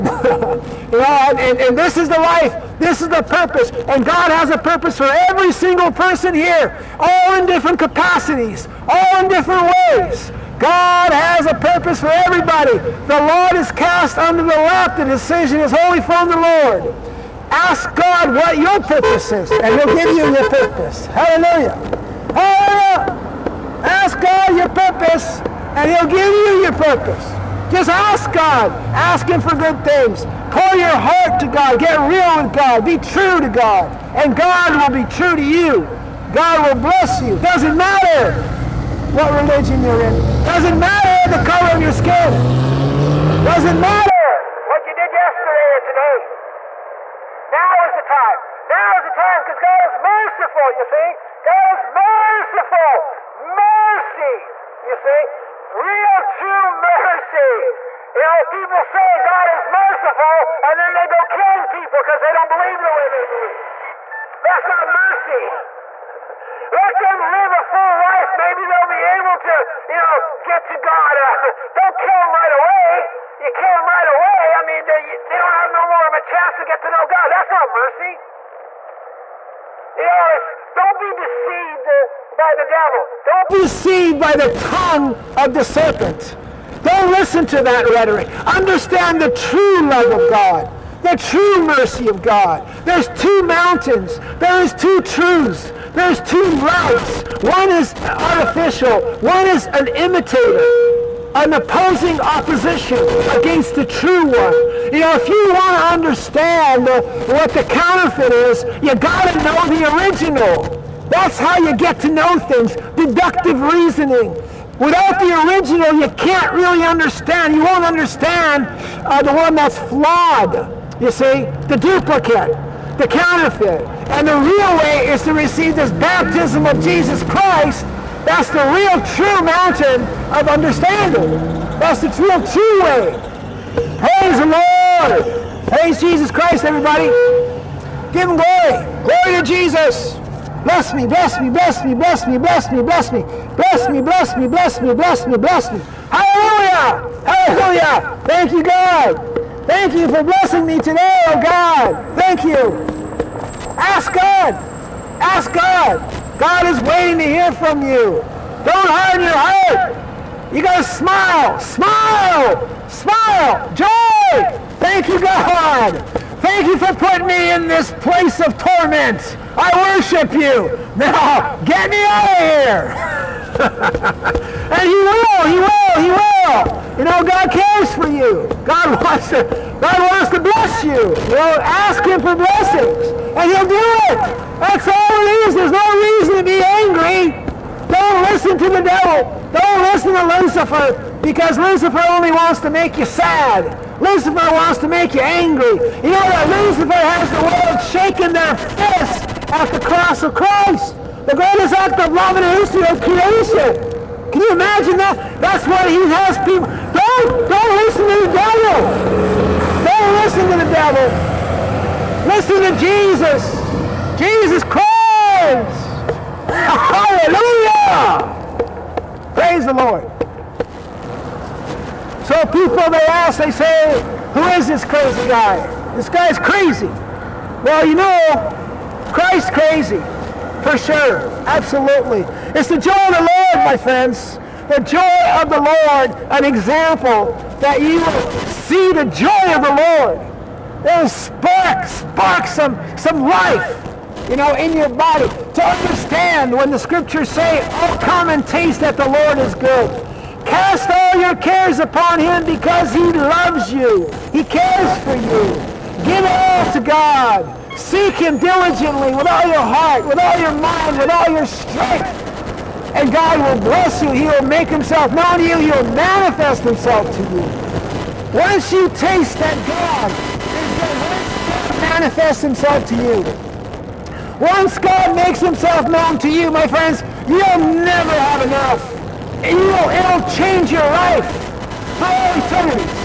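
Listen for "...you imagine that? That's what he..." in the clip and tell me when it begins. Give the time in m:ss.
3:24.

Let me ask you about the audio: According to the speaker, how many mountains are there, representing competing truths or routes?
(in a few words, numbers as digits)
2.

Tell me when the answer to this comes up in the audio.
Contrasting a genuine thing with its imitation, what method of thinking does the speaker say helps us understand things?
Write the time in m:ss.
1:52.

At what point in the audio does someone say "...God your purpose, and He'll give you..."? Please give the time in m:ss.
0:24.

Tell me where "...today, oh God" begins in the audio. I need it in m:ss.
2:30.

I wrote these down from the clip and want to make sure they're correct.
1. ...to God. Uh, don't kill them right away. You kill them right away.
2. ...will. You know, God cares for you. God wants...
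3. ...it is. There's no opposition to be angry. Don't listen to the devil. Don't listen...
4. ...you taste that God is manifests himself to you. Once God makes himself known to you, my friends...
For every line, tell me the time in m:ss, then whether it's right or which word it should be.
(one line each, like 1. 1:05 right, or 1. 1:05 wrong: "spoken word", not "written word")
1. 1:10 right
2. 2:56 right
3. 3:05 wrong: "reason", not "opposition"
4. 4:28 right.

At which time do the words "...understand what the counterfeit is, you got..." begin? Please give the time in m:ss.
1:45.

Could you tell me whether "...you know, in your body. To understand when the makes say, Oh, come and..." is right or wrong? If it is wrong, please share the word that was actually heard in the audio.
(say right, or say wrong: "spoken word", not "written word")
wrong: "scriptures", not "makes".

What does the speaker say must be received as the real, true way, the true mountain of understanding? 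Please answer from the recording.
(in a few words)
baptism of Jesus Christ.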